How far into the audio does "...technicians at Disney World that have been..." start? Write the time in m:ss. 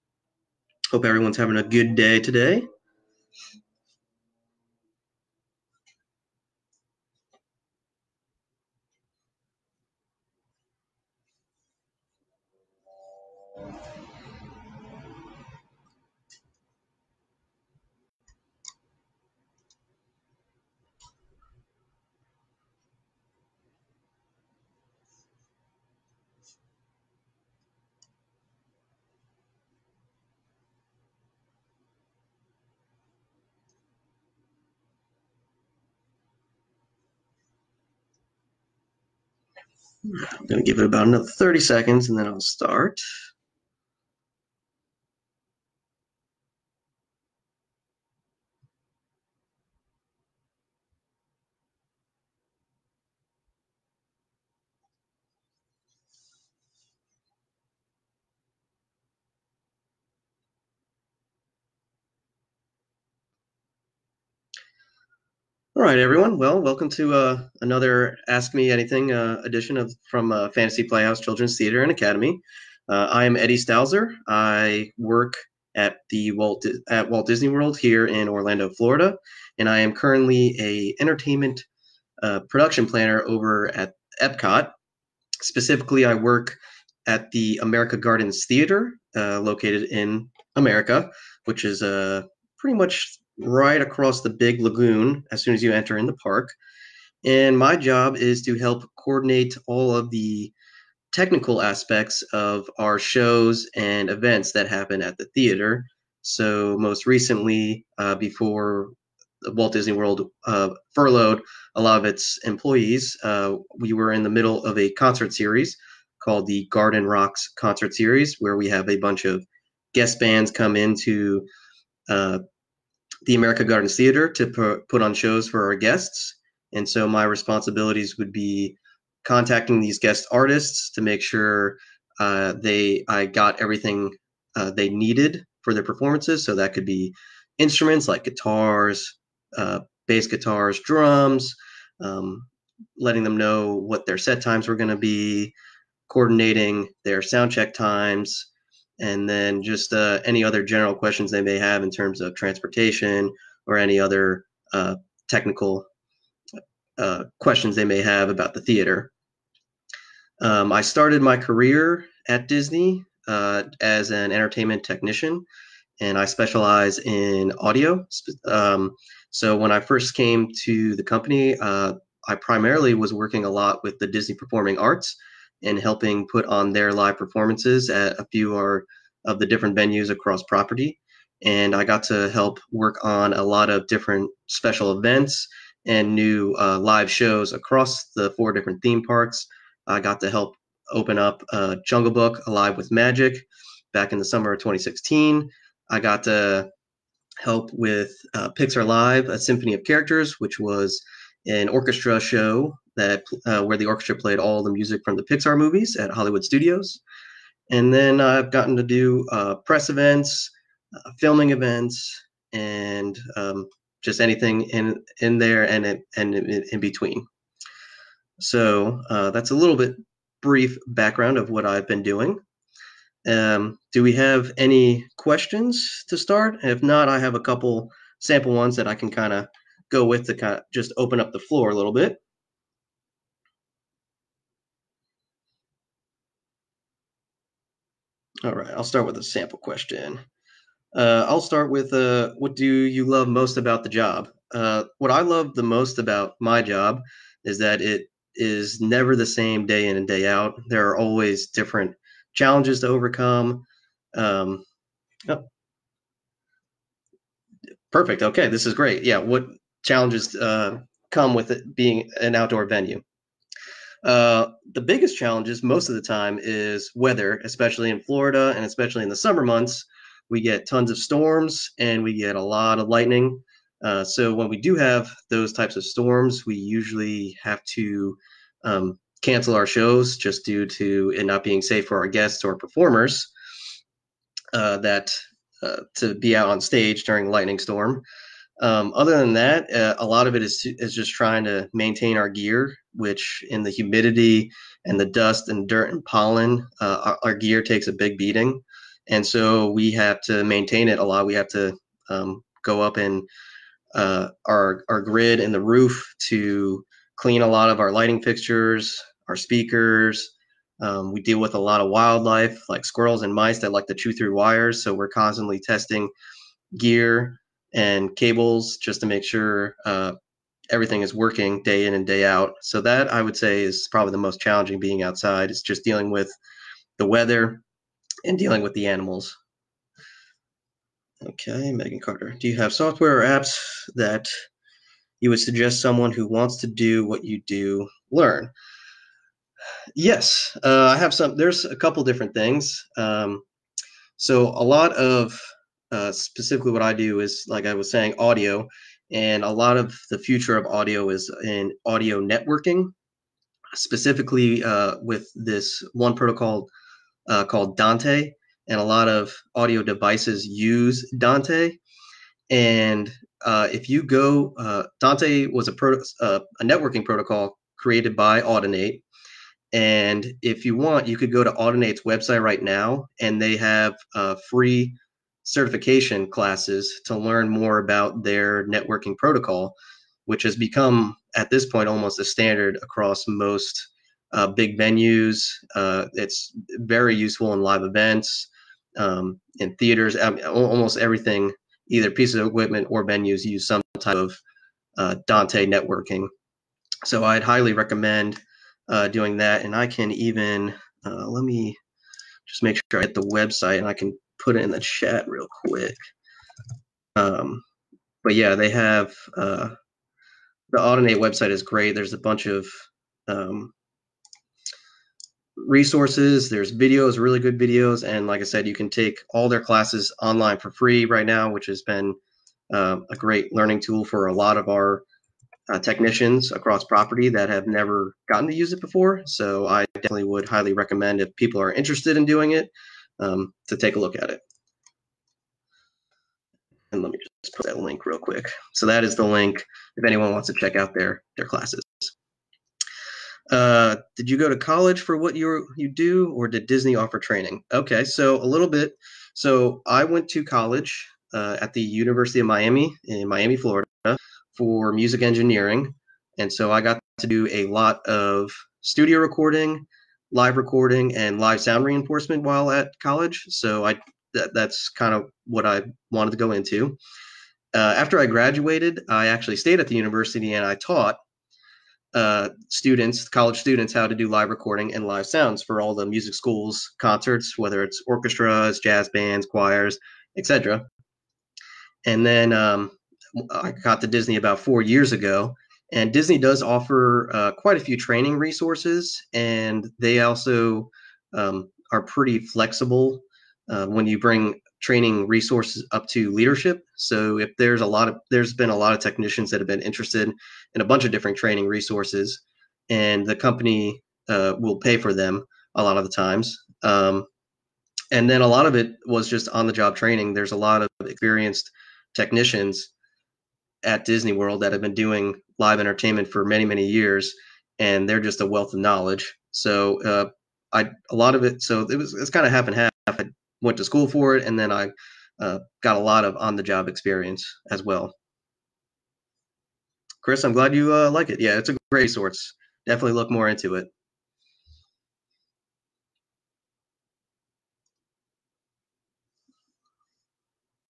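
8:32.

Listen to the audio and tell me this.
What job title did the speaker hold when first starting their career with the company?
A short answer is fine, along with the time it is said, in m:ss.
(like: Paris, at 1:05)
entertainment technician, at 2:44.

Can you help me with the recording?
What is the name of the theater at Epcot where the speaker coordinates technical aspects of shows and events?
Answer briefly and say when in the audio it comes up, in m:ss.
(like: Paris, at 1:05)
America Gardens Theater, at 1:27.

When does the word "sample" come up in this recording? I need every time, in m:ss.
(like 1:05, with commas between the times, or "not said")
3:48, 3:59.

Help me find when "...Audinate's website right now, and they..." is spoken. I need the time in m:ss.
6:11.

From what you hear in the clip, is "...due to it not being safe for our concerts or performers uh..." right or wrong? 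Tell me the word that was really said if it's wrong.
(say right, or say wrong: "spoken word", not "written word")
wrong: "guests", not "concerts".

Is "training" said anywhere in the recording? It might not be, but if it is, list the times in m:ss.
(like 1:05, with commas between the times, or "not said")
7:27, 8:07, 8:14, 8:21, 8:29.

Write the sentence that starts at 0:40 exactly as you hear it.
I'm going to give it about another 30 seconds and then I'll start.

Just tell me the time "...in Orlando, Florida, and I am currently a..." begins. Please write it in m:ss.
1:18.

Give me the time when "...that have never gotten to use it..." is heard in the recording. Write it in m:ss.
7:07.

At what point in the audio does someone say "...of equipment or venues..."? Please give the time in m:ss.
6:32.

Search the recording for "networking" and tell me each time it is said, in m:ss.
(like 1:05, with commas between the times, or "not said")
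5:52, 6:06, 6:18, 6:35.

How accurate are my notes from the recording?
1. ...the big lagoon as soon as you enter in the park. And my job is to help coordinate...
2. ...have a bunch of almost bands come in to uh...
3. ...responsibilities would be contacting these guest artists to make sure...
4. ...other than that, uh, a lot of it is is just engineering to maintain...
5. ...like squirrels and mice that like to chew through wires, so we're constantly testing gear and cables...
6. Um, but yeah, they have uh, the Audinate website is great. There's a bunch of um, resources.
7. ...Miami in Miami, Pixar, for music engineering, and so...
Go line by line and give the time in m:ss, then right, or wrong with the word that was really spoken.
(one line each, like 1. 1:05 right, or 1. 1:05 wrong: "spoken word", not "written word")
1. 1:34 right
2. 1:58 wrong: "guest", not "almost"
3. 2:07 right
4. 4:48 wrong: "trying", not "engineering"
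5. 5:12 right
6. 6:47 right
7. 7:32 wrong: "Florida", not "Pixar".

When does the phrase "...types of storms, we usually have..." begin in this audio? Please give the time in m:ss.
4:35.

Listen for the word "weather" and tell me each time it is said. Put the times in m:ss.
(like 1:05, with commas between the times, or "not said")
4:26, 5:27.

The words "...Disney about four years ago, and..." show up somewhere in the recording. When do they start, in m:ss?
8:04.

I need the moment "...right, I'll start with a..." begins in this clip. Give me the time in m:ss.
3:58.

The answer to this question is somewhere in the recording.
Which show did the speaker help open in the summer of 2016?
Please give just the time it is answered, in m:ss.
3:11.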